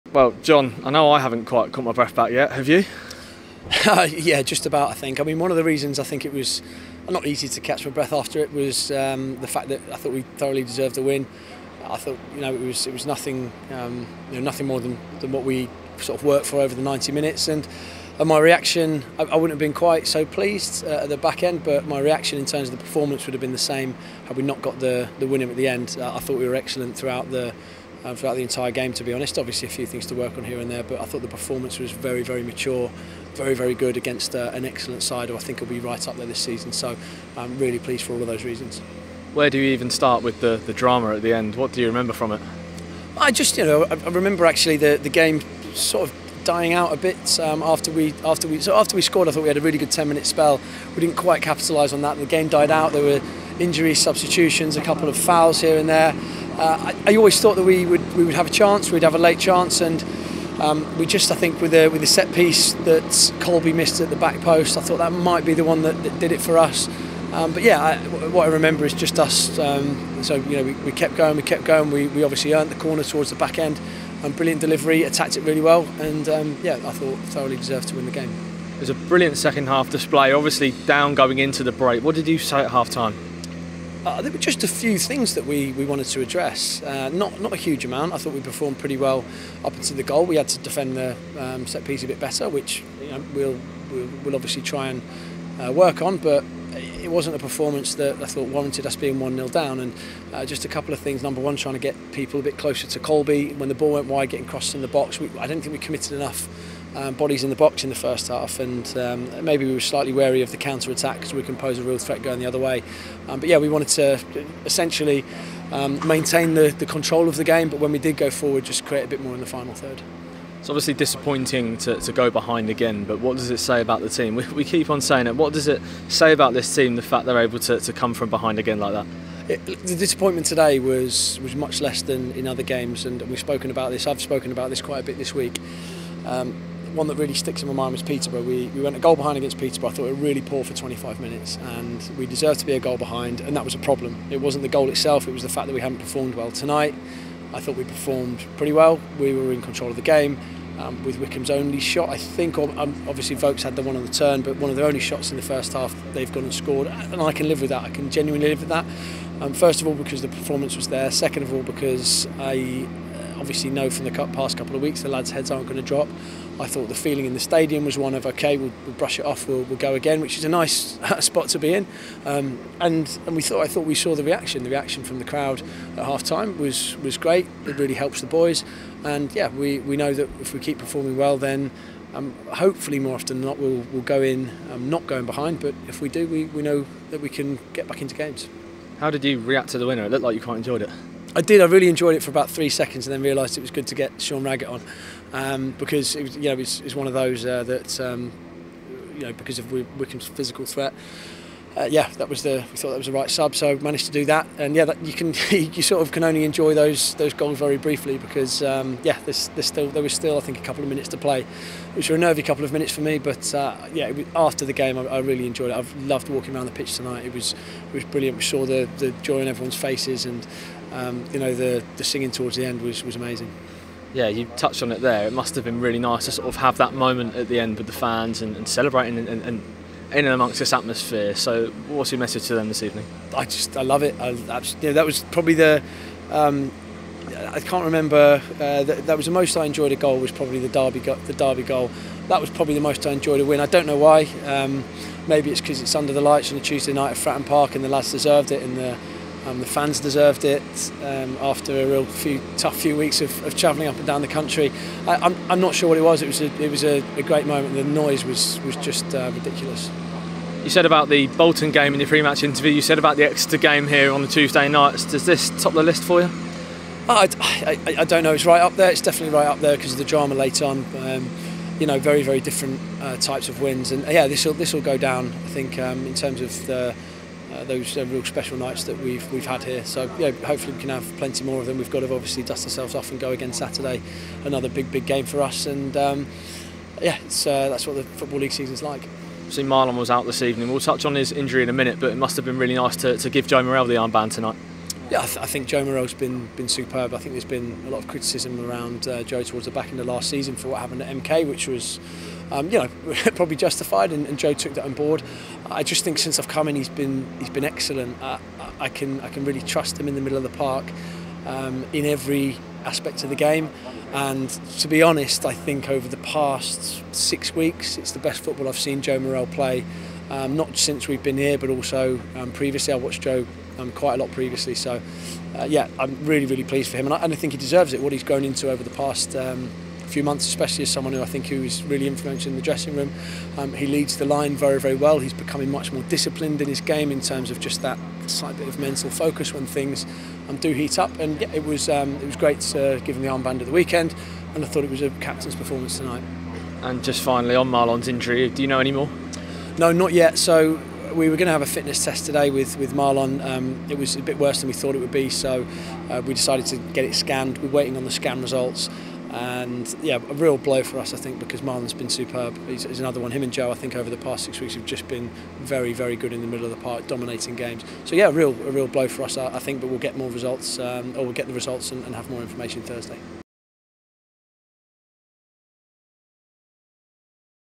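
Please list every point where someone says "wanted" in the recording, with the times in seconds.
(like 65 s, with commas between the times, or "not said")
85 s, 113 s.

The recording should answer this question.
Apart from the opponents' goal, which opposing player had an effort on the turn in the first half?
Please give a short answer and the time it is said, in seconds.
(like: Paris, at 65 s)
Vokes, at 153 s.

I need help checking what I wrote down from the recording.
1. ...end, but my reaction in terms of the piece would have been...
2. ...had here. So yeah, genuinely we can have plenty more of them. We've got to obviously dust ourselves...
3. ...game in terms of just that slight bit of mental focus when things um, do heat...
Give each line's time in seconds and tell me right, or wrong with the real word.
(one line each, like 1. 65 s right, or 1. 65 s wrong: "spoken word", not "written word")
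1. 21 s wrong: "performance", not "piece"
2. 279 s wrong: "hopefully", not "genuinely"
3. 336 s right.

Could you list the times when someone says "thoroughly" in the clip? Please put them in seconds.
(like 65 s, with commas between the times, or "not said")
10 s, 77 s.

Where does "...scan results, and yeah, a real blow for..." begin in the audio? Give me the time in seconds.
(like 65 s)
358 s.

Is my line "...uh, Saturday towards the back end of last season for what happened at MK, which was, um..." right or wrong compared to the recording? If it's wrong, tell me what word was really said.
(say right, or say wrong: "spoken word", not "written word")
wrong: "Joe", not "Saturday".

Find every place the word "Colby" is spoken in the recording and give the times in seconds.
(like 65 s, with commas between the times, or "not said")
63 s, 102 s.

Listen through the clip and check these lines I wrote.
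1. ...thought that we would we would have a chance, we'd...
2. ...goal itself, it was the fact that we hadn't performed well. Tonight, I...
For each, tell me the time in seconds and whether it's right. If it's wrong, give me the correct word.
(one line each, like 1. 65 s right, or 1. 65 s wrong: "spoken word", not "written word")
1. 57 s right
2. 144 s right.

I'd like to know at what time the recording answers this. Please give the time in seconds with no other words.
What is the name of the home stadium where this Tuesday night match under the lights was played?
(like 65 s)
247 s.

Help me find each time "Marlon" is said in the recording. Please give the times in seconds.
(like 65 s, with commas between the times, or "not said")
289 s, 347 s, 352 s, 361 s.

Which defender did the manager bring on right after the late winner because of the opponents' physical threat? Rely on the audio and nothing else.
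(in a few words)
Sean Raggett.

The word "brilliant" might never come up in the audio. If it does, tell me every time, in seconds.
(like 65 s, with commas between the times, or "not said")
74 s, 78 s, 218 s.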